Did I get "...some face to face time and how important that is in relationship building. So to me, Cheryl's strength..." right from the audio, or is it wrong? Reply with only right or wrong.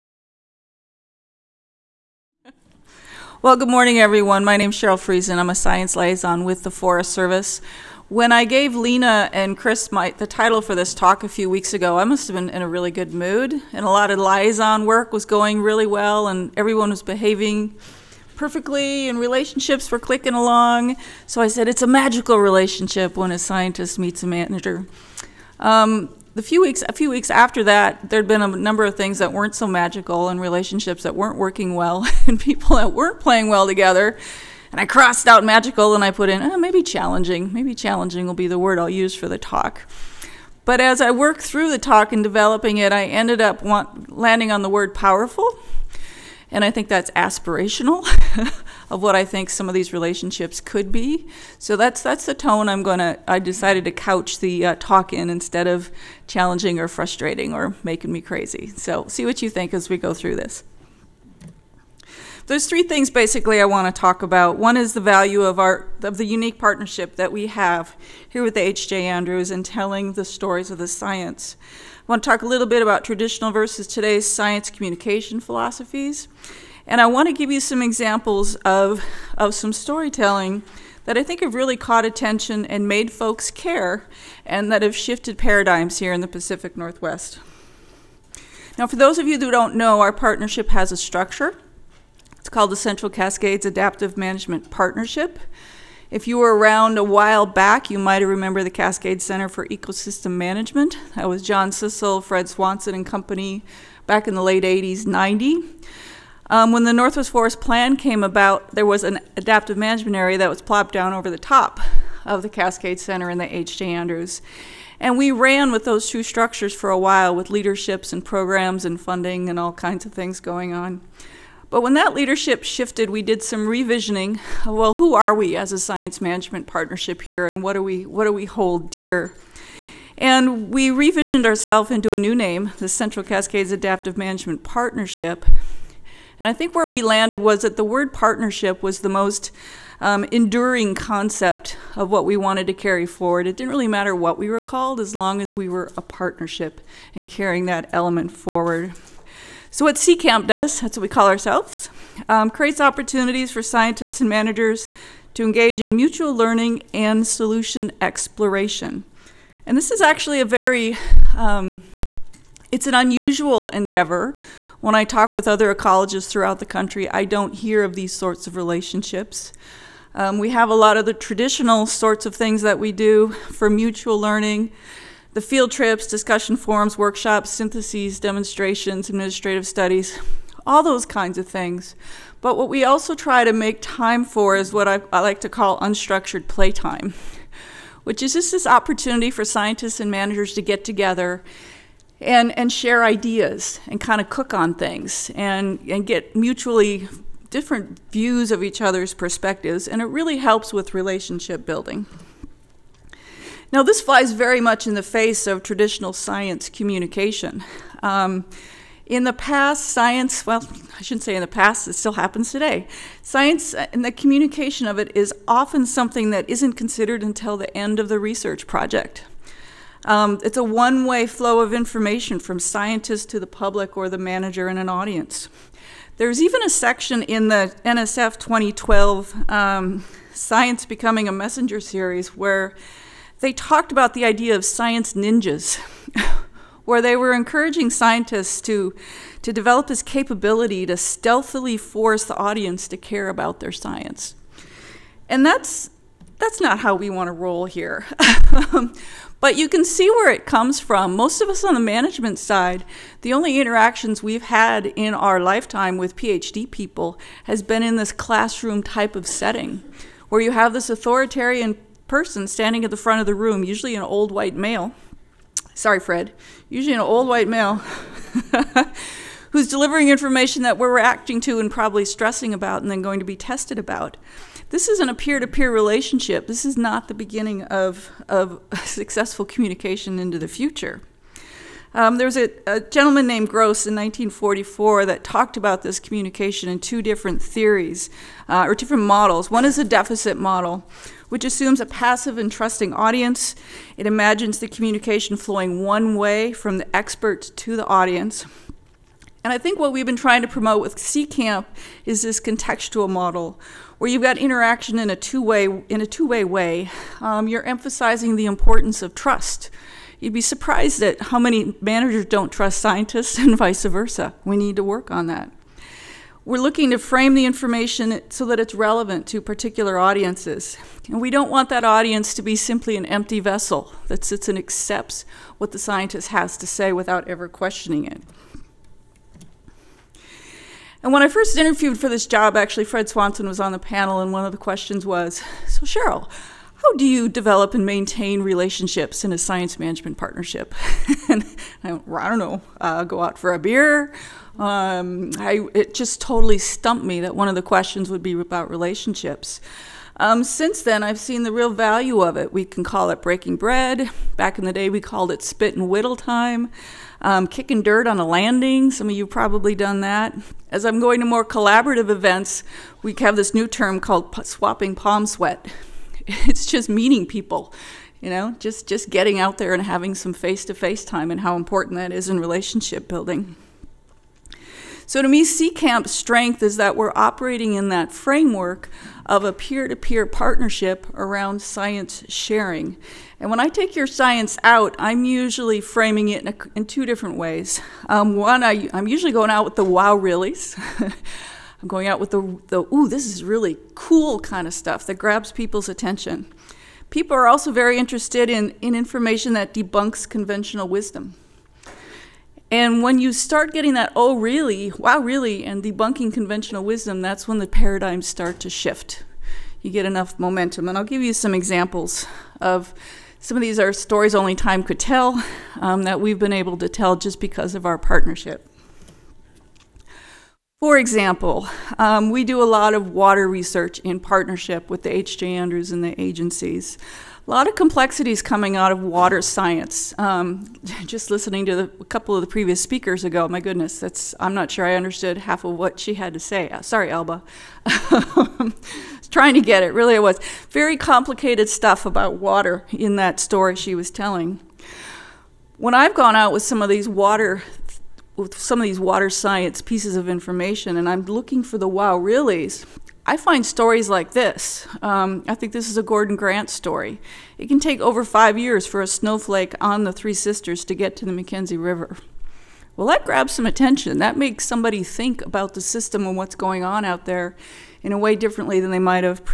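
wrong.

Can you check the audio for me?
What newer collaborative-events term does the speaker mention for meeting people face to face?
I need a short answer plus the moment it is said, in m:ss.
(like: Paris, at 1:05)
swapping palm sweat, at 6:04.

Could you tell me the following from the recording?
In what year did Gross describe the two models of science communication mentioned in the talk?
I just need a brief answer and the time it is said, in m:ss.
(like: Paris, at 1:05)
1944, at 4:43.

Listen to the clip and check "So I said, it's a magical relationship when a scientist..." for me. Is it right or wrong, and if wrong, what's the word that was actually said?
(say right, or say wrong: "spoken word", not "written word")
right.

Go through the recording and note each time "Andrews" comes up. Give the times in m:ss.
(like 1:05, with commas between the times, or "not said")
1:09, 1:53, 7:05.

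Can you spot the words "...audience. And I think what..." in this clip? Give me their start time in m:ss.
4:57.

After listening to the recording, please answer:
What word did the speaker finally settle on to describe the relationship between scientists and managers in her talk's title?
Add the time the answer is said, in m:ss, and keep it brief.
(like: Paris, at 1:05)
powerful, at 0:44.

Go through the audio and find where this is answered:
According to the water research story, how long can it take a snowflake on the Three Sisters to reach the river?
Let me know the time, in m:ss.
7:37.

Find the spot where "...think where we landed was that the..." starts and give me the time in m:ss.
2:16.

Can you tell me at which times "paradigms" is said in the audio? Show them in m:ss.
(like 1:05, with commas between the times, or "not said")
1:25, 6:47.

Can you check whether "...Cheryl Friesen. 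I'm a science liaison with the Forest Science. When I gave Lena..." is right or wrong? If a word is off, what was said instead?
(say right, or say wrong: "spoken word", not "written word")
wrong: "Service", not "Science".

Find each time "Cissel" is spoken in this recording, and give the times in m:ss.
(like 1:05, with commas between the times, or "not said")
1:41.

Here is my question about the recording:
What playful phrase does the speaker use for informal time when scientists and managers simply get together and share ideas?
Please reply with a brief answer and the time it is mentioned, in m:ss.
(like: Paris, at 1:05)
unstructured playtime, at 3:05.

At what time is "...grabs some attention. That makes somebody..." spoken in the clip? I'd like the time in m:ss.
7:43.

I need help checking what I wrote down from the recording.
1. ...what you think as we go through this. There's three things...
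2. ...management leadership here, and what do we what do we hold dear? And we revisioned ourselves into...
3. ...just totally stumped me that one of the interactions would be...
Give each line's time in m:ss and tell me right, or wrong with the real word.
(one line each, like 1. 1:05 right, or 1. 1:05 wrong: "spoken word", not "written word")
1. 0:59 right
2. 2:06 wrong: "partnership", not "leadership"
3. 5:45 wrong: "questions", not "interactions".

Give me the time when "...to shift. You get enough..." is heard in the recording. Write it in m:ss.
6:48.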